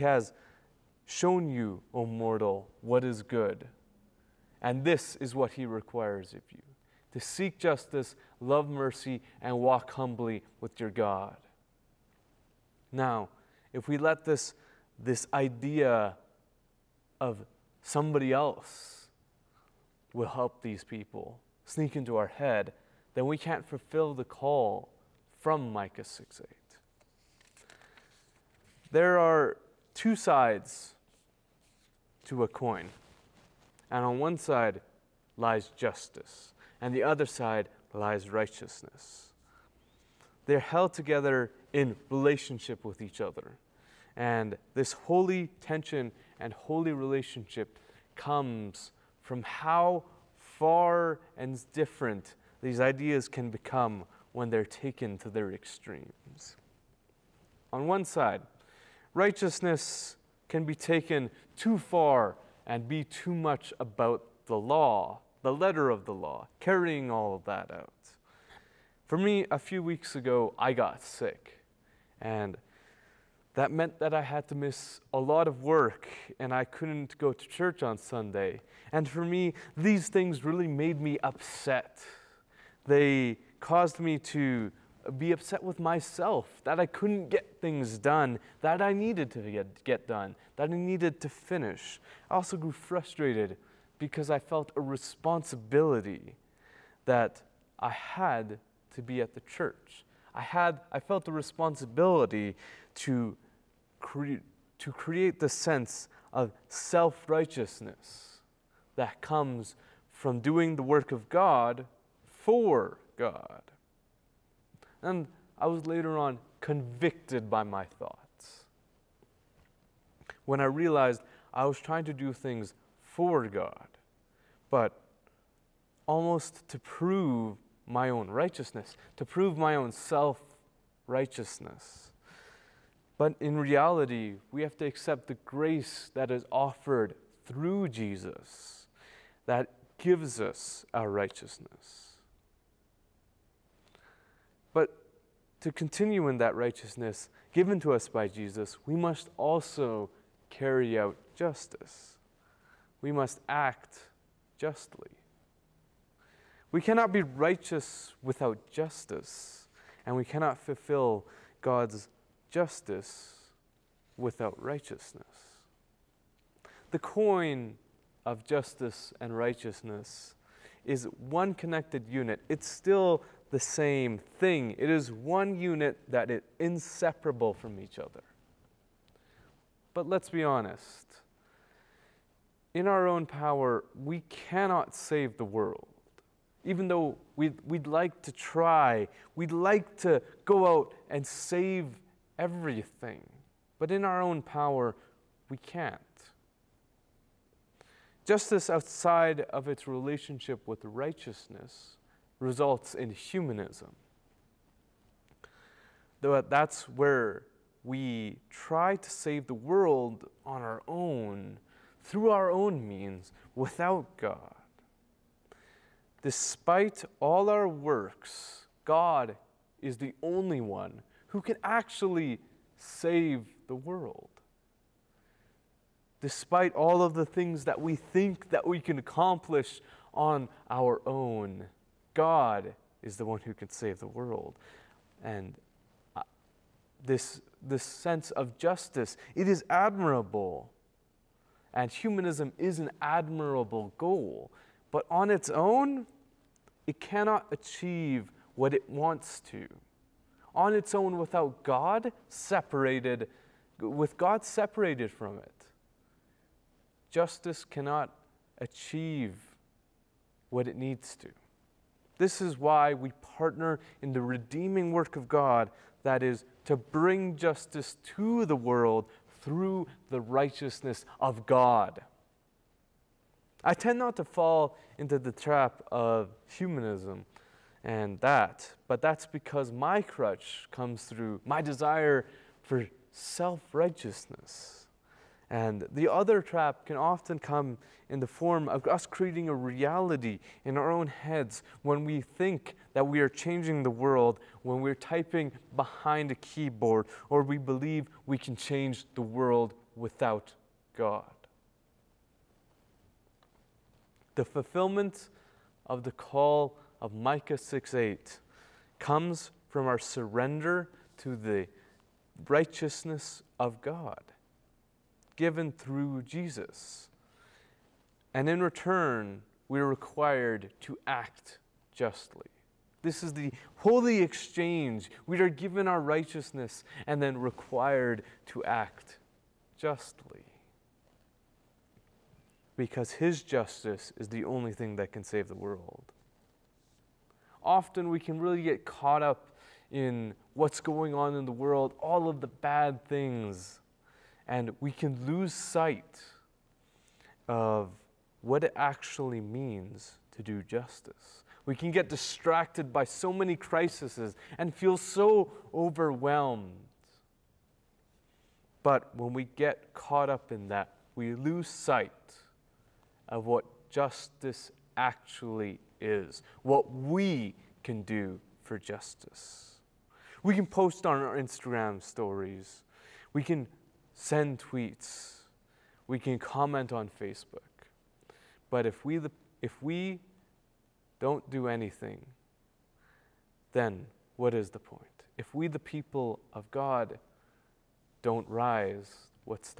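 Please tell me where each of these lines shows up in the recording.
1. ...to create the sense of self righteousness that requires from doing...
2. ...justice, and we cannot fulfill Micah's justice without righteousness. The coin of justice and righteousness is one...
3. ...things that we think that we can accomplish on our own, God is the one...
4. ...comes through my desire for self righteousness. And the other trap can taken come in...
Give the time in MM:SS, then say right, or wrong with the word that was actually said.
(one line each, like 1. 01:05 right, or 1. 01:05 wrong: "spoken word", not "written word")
1. 01:44 wrong: "comes", not "requires"
2. 02:38 wrong: "God", not "Micah"
3. 03:47 right
4. 04:40 wrong: "often", not "taken".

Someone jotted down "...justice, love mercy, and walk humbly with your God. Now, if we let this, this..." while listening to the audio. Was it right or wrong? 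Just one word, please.
right.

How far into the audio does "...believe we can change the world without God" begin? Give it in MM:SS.
04:57.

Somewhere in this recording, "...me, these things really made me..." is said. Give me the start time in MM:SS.
01:19.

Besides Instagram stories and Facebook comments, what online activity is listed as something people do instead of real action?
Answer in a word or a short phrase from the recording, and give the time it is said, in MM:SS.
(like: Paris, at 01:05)
send tweets, at 06:14.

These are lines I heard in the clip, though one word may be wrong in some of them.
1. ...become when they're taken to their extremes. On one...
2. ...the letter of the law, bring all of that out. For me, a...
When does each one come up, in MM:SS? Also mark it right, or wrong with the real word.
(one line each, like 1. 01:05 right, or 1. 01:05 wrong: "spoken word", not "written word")
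1. 00:53 right
2. 01:05 wrong: "carrying", not "bring".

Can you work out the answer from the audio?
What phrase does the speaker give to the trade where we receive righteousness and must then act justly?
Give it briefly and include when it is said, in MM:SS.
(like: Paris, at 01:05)
the holy exchange, at 05:23.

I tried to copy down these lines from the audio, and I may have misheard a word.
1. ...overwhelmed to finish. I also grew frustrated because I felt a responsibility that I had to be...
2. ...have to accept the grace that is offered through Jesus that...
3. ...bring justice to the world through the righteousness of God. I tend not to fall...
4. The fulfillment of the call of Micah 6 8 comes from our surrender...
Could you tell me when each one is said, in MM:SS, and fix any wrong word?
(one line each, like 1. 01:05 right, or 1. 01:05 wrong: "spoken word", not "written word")
1. 01:30 wrong: "needed", not "overwhelmed"
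2. 02:14 right
3. 04:26 right
4. 05:04 right.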